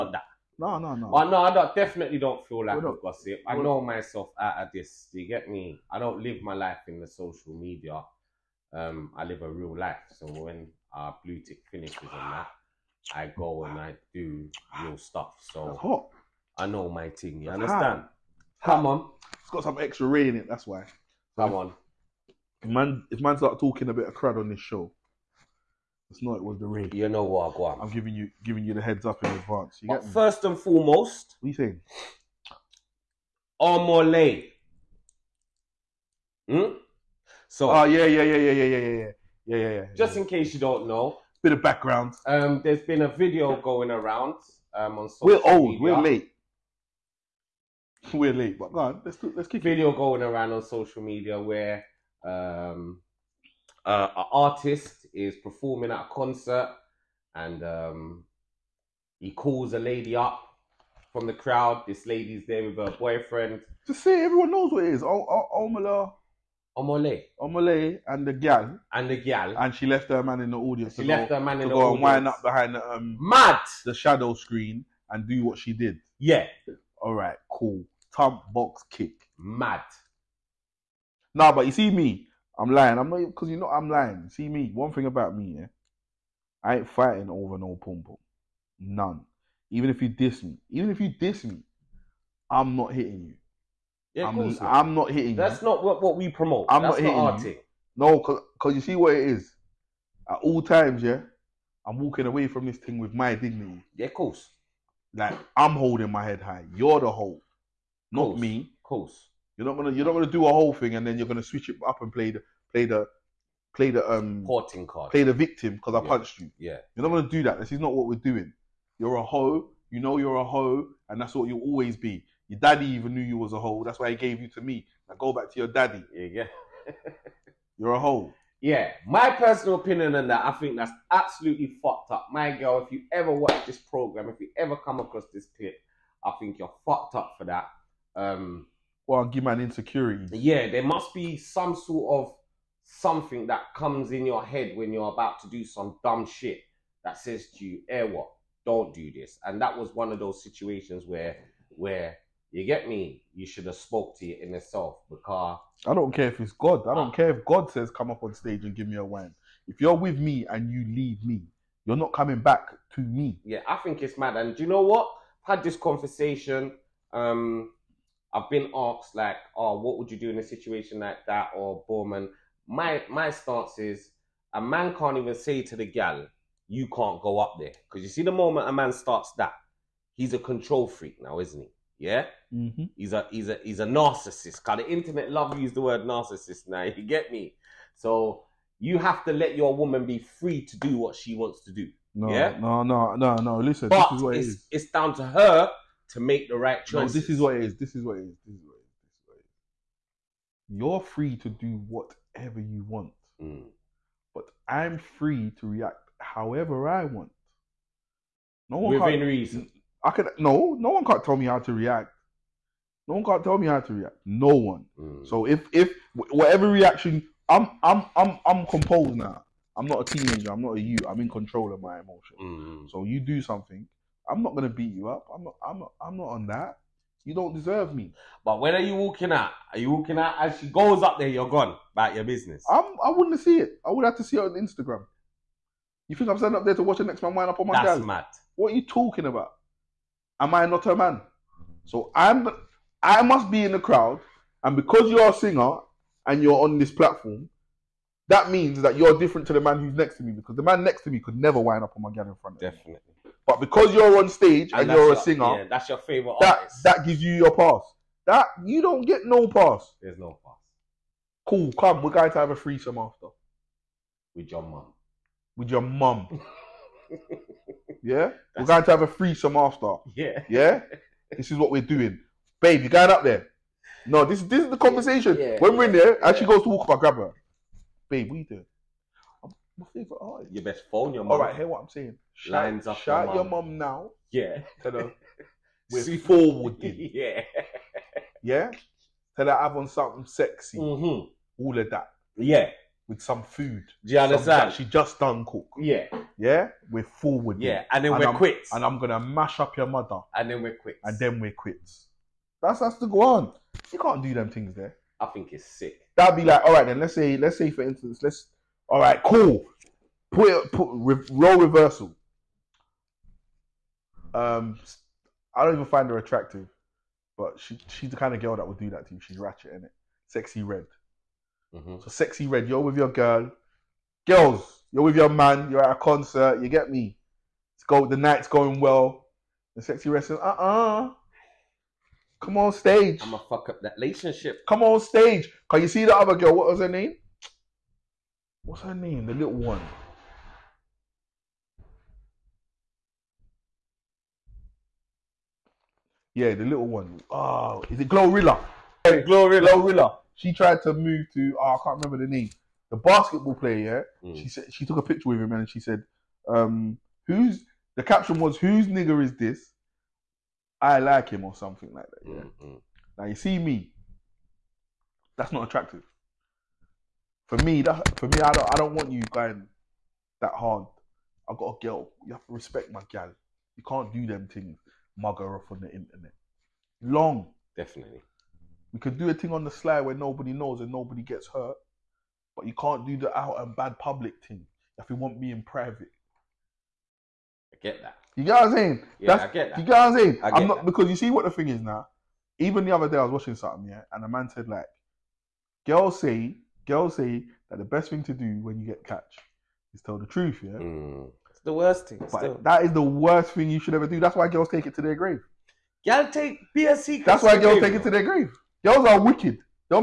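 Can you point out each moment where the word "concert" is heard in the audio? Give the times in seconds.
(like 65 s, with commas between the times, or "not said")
56 s, 325 s.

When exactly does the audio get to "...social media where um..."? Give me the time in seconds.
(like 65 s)
50 s.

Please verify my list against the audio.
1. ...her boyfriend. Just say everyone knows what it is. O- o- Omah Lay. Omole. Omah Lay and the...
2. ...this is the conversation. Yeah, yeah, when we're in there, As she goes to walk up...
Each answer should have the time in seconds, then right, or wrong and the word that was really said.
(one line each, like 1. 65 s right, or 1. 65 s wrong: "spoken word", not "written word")
1. 62 s right
2. 274 s right.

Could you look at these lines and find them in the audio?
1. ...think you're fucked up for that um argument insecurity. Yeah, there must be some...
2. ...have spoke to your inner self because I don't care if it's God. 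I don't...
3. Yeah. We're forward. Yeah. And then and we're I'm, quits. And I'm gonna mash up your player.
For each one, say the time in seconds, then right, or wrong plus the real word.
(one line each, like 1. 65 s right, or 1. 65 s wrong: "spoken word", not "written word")
1. 136 s right
2. 153 s right
3. 296 s wrong: "mother", not "player".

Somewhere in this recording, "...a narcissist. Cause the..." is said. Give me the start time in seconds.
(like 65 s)
183 s.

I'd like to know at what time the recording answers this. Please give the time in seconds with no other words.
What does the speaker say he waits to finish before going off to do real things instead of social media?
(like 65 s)
11 s.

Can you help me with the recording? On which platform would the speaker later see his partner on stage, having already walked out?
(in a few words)
Instagram.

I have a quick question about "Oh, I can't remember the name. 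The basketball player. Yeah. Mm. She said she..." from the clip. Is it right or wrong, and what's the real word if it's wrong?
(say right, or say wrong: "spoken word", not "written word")
right.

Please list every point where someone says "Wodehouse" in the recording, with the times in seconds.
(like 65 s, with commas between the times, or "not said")
not said.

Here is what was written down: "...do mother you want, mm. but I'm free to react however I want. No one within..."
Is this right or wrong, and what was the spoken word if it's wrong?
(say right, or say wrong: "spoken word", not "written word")
wrong: "whatever", not "mother".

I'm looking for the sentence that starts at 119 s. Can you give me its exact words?
You know you're a hoe, and that's what you'll always be.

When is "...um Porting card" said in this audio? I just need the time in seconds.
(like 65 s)
114 s.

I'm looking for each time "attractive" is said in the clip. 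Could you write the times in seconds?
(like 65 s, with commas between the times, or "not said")
316 s, 365 s.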